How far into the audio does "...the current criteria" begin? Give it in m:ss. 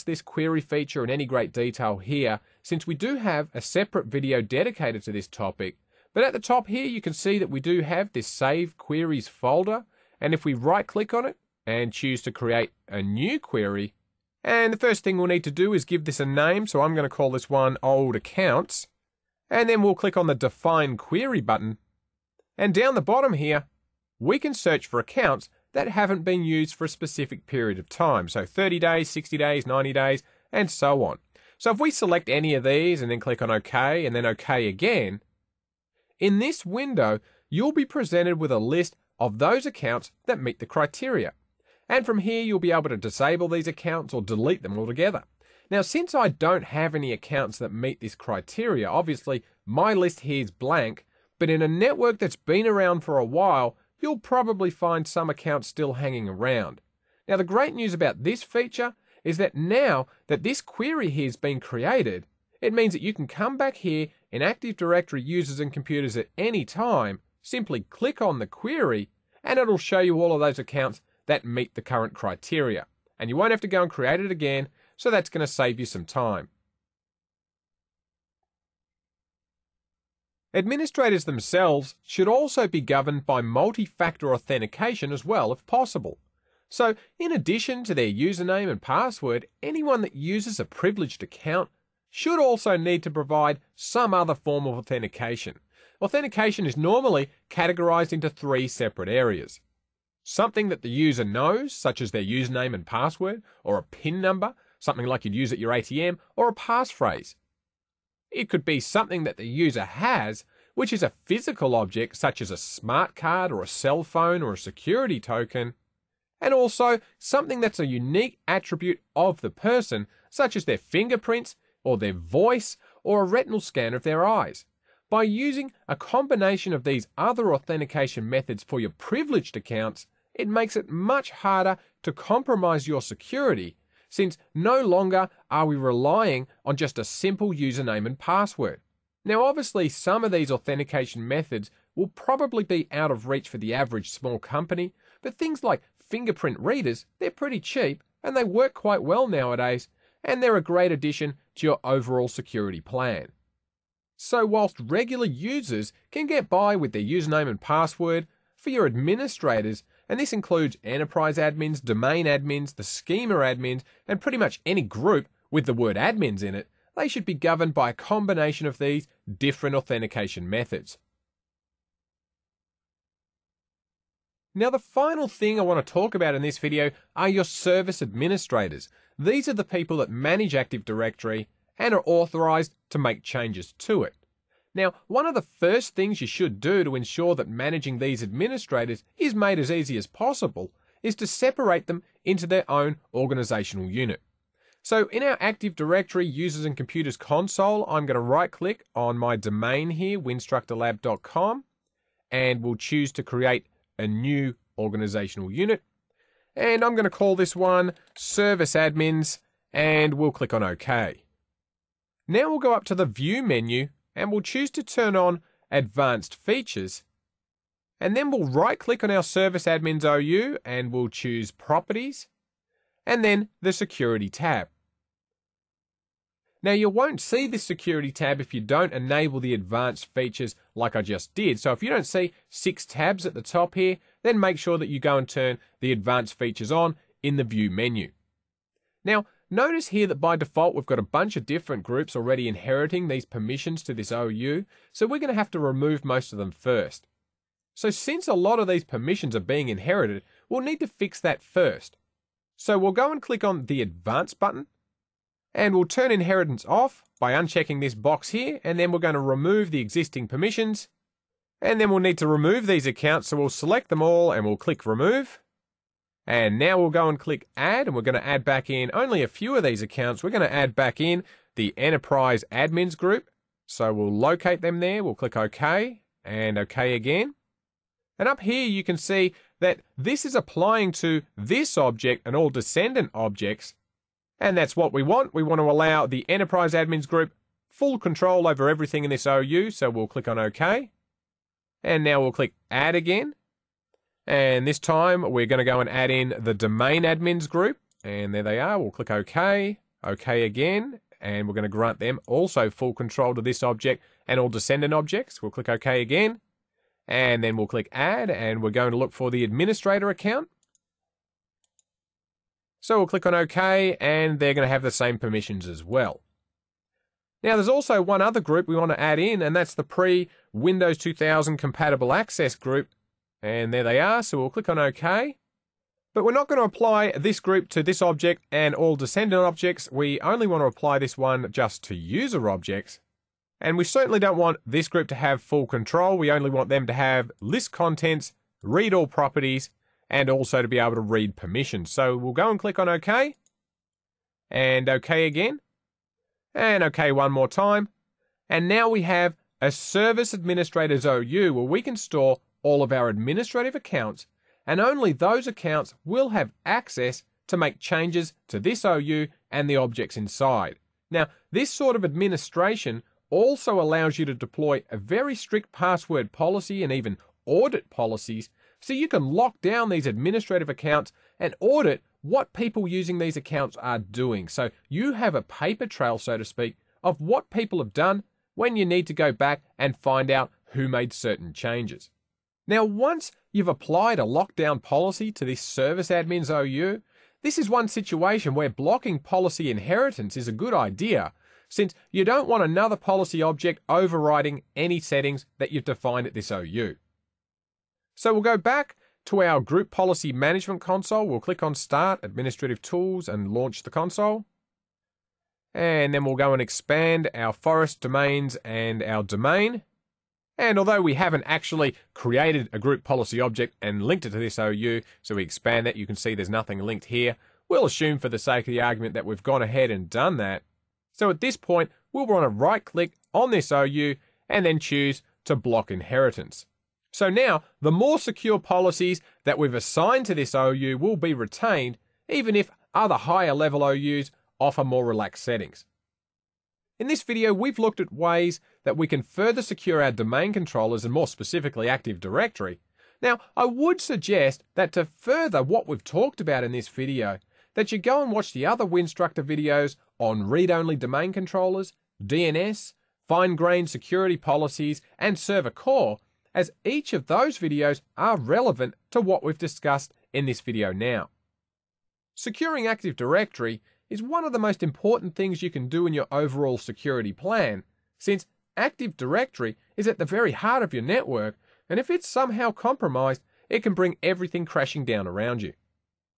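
1:11.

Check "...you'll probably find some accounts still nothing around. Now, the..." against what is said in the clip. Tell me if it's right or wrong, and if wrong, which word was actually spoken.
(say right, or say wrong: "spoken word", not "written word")
wrong: "hanging", not "nothing".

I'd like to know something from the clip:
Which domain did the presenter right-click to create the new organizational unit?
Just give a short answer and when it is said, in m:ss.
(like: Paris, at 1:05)
winstructorlab.com, at 3:20.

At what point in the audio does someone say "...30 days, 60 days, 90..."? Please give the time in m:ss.
0:28.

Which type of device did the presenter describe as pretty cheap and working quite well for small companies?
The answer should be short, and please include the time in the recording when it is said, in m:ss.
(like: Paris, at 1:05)
fingerprint readers, at 2:25.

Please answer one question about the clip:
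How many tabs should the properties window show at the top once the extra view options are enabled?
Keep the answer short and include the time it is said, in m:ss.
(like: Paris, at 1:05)
6, at 3:52.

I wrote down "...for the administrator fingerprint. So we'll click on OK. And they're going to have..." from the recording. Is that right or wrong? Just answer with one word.
wrong.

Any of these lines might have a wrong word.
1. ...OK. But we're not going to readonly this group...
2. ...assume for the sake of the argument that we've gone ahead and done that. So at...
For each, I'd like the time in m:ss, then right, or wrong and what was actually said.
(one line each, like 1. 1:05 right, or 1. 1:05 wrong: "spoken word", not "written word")
1. 5:24 wrong: "apply", not "readonly"
2. 6:57 right.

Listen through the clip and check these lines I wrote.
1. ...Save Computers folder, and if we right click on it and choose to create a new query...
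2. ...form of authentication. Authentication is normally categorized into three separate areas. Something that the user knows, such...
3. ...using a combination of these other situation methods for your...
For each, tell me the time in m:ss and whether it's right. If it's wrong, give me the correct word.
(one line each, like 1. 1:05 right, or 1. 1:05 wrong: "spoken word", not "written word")
1. 0:08 wrong: "Queries", not "Computers"
2. 1:34 right
3. 2:05 wrong: "authentication", not "situation".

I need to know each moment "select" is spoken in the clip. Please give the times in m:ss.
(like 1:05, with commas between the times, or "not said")
0:31, 4:23.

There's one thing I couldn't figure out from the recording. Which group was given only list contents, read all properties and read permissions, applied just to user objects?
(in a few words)
pre Windows 2000 compatible access group.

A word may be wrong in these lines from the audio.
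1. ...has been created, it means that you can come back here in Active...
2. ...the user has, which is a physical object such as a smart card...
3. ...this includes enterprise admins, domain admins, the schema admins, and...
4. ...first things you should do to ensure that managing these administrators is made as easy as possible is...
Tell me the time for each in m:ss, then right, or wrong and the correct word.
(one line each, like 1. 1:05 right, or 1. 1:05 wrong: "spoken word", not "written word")
1. 1:01 right
2. 1:49 right
3. 2:40 right
4. 3:05 right.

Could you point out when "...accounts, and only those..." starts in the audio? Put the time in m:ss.
5:53.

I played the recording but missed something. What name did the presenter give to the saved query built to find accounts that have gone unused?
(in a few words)
old accounts.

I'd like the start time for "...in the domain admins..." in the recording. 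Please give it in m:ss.
4:56.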